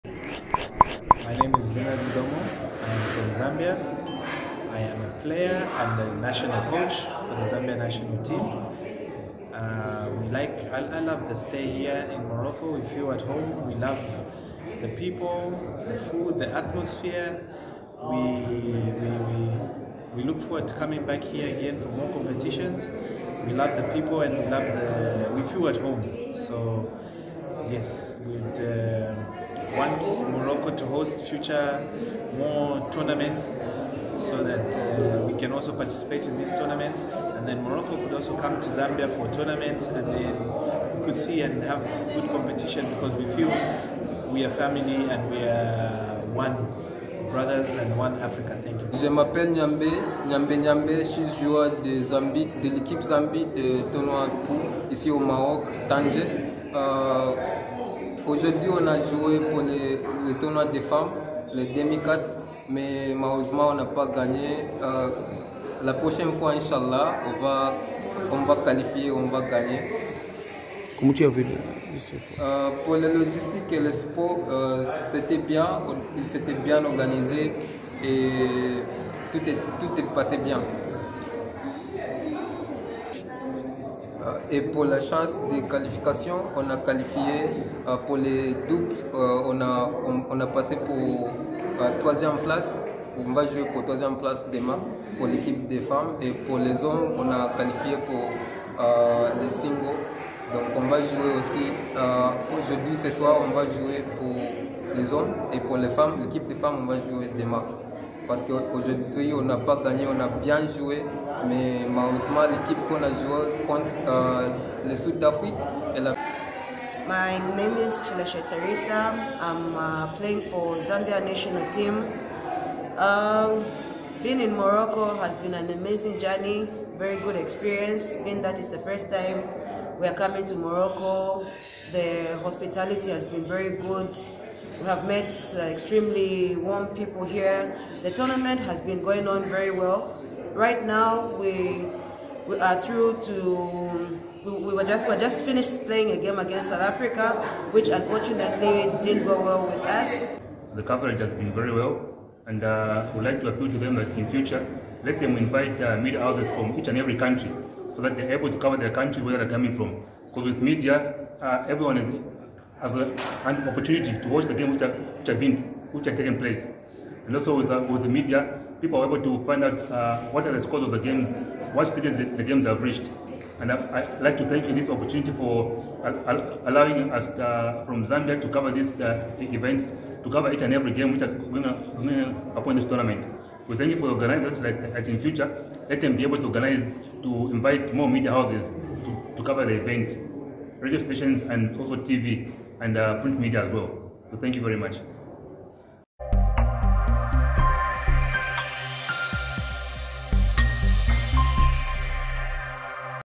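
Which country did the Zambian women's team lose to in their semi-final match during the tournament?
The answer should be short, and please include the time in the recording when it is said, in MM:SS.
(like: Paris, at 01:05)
South Africa, at 01:54.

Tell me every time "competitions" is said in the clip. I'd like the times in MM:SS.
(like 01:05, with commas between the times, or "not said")
00:22, 00:42.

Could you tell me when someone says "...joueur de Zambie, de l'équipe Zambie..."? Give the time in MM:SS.
00:51.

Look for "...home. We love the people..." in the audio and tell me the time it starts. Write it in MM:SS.
00:13.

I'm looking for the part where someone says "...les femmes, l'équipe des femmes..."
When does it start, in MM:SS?
01:45.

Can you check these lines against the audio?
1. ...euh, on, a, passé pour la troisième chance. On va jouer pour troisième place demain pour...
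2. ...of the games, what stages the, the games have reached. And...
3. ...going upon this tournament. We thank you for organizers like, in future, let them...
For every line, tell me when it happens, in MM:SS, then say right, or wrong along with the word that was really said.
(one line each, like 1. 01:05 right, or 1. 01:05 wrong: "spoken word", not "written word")
1. 01:29 wrong: "place", not "chance"
2. 02:50 right
3. 03:01 right.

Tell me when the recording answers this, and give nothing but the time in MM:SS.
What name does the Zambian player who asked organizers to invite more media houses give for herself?
01:58.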